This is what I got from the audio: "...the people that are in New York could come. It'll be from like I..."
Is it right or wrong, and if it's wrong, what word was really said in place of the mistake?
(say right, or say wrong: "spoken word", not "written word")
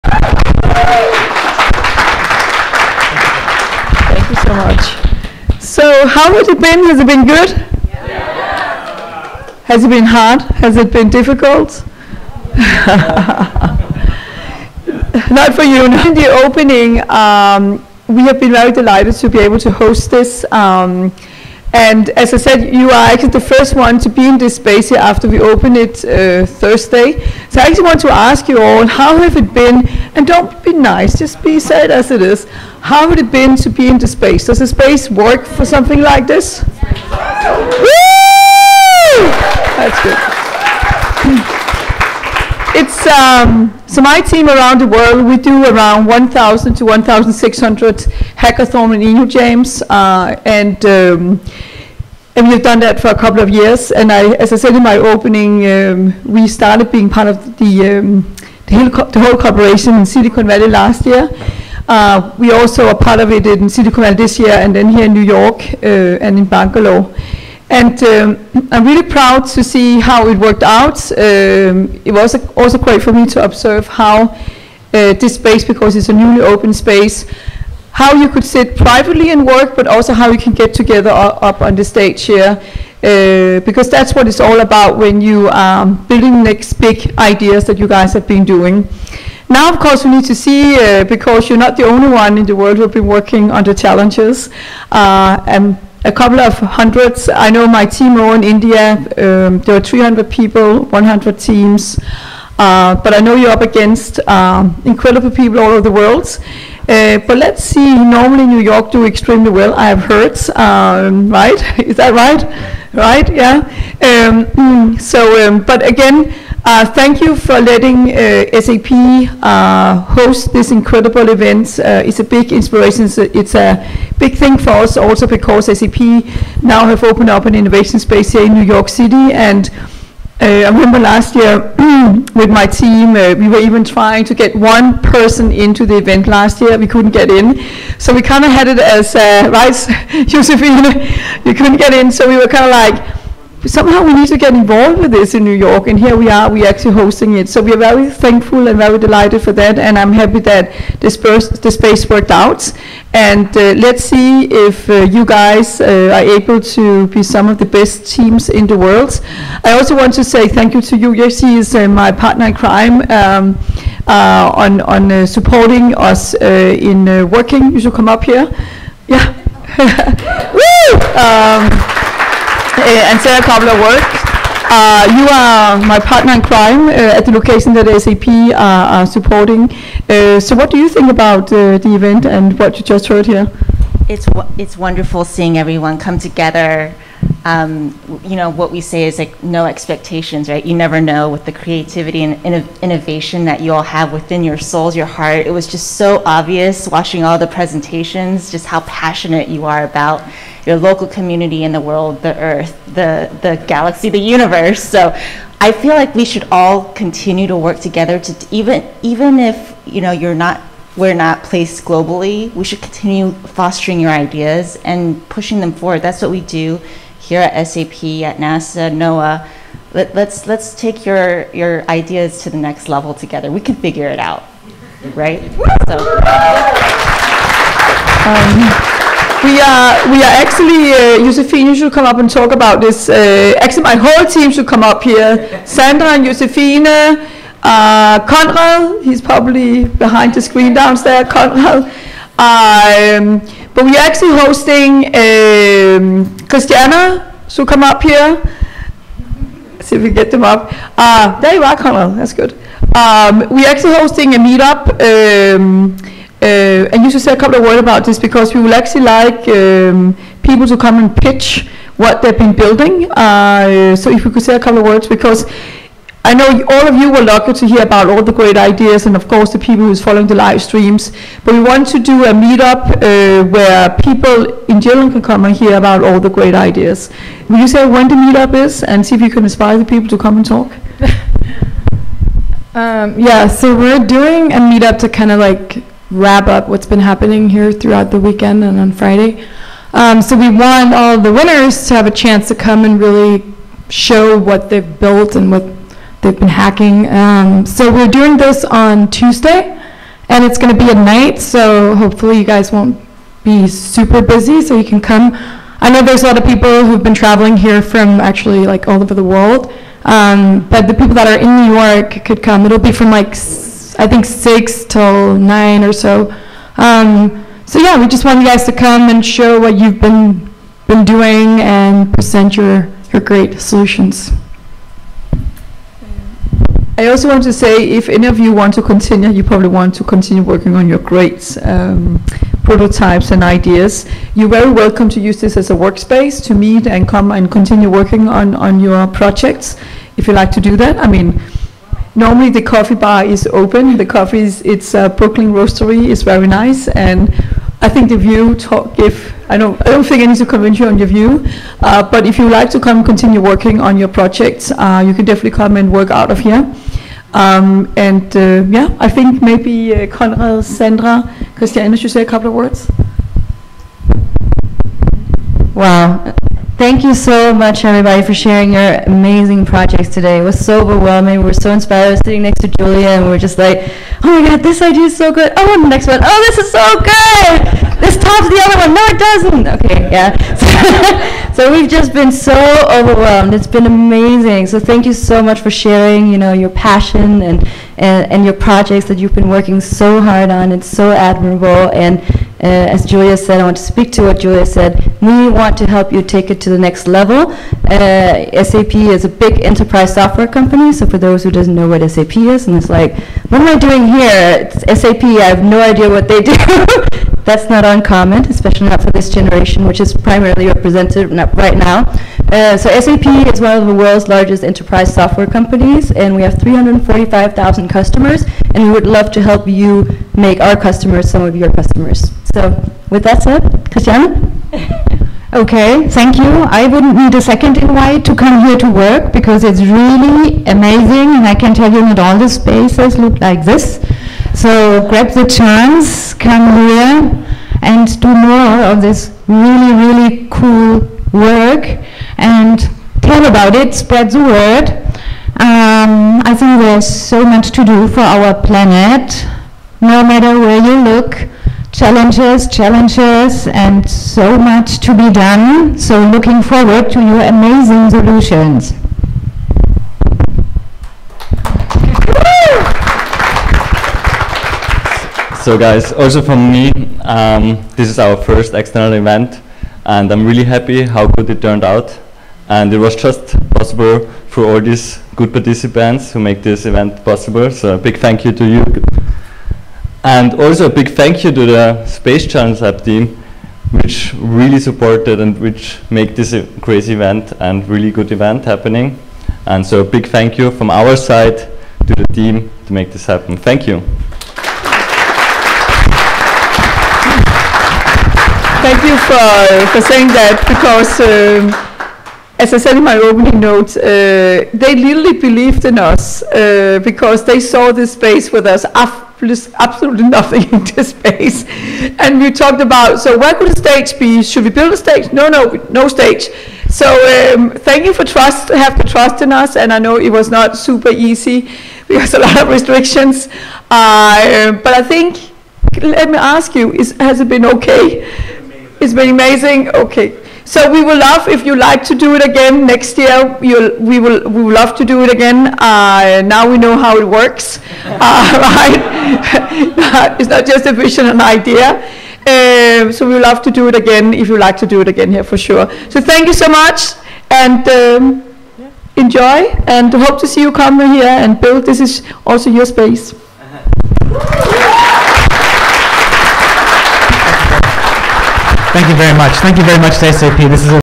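right.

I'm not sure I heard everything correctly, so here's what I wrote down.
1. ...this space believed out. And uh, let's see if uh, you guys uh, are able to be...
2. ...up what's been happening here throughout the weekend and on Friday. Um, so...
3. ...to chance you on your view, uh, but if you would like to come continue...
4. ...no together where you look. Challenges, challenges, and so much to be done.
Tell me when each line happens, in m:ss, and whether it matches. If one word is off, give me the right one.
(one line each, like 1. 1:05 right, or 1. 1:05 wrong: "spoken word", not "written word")
1. 2:31 wrong: "worked", not "believed"
2. 4:46 right
3. 5:50 wrong: "convince", not "chance"
4. 7:30 wrong: "matter", not "together".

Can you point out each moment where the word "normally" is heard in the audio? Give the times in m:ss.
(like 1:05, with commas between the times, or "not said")
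1:47, 5:42.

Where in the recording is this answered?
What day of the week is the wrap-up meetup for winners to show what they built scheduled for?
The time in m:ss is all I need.
4:59.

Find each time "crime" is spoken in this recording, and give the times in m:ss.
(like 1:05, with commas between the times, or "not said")
2:42, 2:56.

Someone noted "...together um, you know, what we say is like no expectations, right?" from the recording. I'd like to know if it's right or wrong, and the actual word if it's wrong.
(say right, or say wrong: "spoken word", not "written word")
right.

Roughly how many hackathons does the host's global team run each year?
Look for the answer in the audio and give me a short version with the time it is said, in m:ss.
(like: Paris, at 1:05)
1,000 to 1,600, at 0:46.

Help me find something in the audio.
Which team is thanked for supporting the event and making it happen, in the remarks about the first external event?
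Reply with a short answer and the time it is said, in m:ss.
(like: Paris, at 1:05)
Space Challenge Lab team, at 8:02.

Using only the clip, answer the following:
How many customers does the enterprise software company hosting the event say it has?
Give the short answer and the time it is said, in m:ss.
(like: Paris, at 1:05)
345,000, at 6:56.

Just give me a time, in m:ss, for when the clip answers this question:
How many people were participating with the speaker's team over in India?
1:39.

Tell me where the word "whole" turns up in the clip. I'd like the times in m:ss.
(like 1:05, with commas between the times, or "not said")
0:59, 3:53.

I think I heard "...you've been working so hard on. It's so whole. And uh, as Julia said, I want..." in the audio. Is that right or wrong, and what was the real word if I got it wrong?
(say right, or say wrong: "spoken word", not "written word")
wrong: "admirable", not "whole".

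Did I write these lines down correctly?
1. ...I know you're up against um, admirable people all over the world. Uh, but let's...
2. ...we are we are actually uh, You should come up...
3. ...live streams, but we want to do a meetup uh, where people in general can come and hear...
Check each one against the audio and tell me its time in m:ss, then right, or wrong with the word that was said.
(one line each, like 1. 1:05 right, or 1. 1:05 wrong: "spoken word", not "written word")
1. 1:43 wrong: "incredible", not "admirable"
2. 3:49 right
3. 4:30 right.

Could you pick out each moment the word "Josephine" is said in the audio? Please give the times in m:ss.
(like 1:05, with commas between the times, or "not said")
2:20, 3:56.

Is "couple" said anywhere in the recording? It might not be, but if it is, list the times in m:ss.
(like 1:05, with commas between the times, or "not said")
0:53, 1:36, 4:17, 4:24, 6:02.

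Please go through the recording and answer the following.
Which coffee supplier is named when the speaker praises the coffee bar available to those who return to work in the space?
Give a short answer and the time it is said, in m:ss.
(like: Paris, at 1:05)
Brooklyn Roastery, at 5:45.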